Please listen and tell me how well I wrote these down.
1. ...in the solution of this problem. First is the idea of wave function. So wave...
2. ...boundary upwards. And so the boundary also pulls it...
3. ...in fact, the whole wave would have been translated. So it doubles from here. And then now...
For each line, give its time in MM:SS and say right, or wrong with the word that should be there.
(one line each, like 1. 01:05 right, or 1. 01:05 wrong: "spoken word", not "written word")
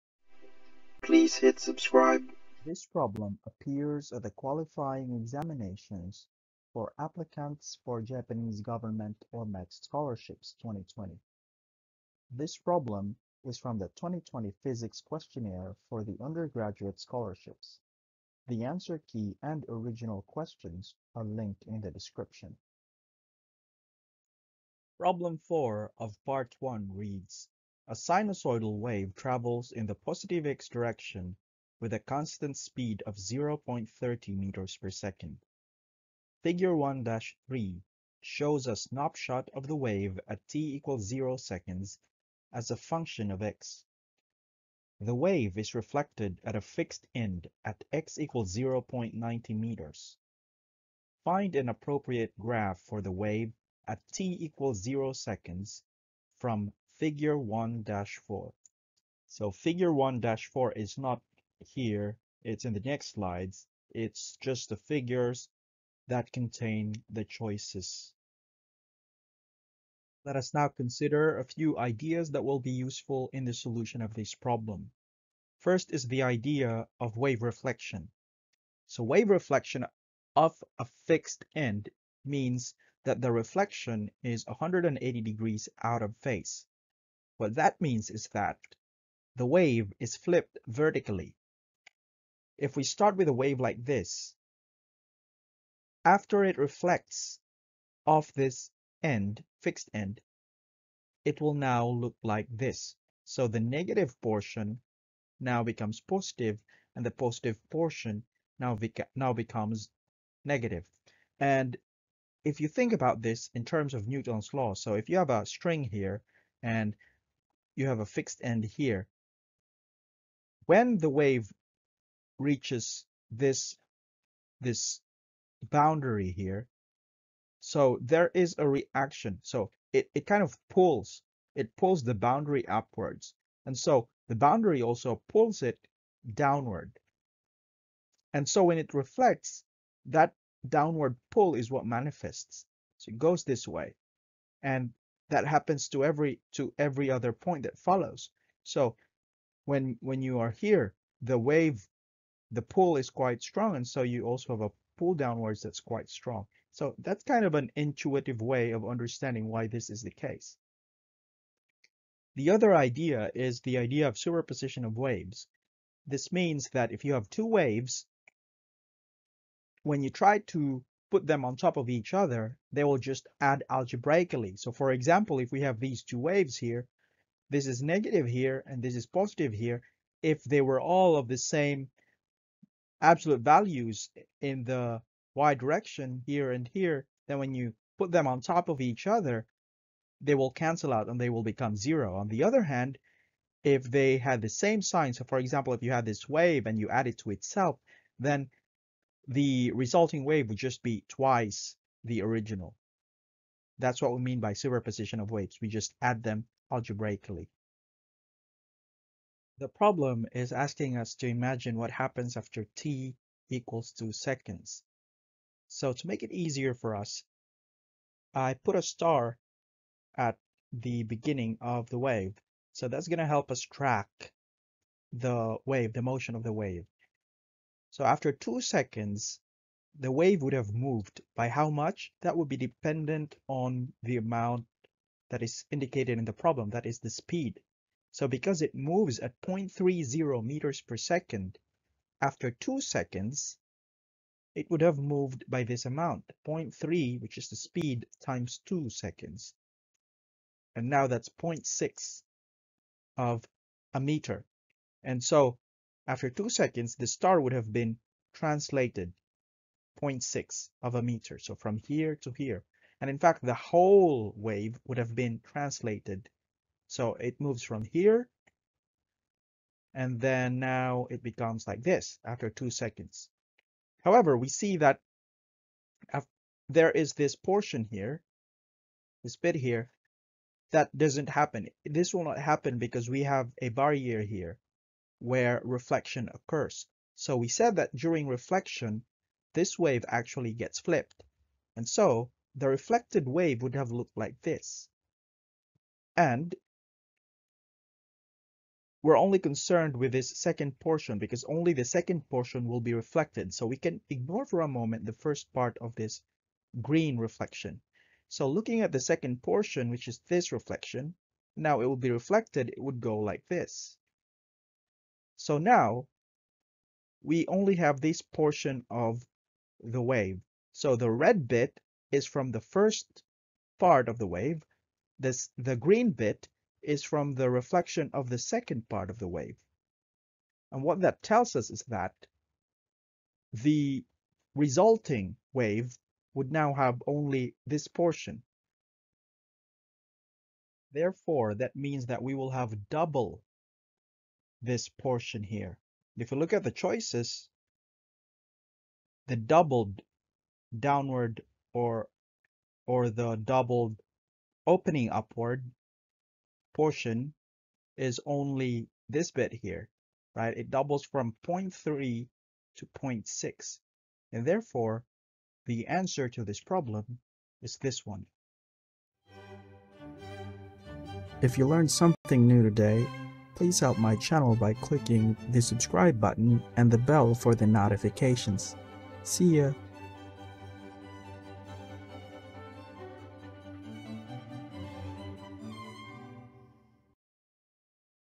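1. 01:13 wrong: "reflection", not "function"
2. 02:12 right
3. 04:23 wrong: "moves", not "doubles".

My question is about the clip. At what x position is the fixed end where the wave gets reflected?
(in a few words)
0.90 meters.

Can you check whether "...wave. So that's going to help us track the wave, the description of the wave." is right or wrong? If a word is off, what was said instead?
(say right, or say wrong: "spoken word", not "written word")
wrong: "motion", not "description".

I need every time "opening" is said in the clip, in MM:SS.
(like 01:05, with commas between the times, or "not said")
05:54.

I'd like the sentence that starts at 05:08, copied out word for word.
So looking at the second portion, which is this reflection, now it will be reflected, it would go like this.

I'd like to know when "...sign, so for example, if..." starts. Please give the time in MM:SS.
03:14.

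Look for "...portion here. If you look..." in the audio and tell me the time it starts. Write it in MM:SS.
05:44.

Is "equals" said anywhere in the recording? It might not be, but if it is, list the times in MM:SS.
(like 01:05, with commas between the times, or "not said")
00:40, 00:48, 00:54, 03:33.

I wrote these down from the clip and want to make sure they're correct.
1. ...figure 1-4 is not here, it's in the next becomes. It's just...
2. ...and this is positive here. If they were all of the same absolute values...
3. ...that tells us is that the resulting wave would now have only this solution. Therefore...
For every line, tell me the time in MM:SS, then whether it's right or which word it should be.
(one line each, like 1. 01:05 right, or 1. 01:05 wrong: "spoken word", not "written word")
1. 00:59 wrong: "slides", not "becomes"
2. 02:58 right
3. 05:31 wrong: "portion", not "solution".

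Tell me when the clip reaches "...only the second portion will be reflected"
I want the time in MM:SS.
05:01.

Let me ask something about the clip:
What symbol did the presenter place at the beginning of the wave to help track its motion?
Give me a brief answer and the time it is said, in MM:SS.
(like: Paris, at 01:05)
A star, at 03:38.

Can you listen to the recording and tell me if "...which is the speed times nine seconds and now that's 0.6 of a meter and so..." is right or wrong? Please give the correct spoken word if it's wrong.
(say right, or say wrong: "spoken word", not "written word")
wrong: "two", not "nine".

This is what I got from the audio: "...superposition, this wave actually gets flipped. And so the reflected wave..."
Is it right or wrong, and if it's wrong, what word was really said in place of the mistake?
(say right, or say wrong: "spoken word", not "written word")
wrong: "reflection", not "superposition".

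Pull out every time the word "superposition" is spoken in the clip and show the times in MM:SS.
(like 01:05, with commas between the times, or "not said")
02:44, 03:24.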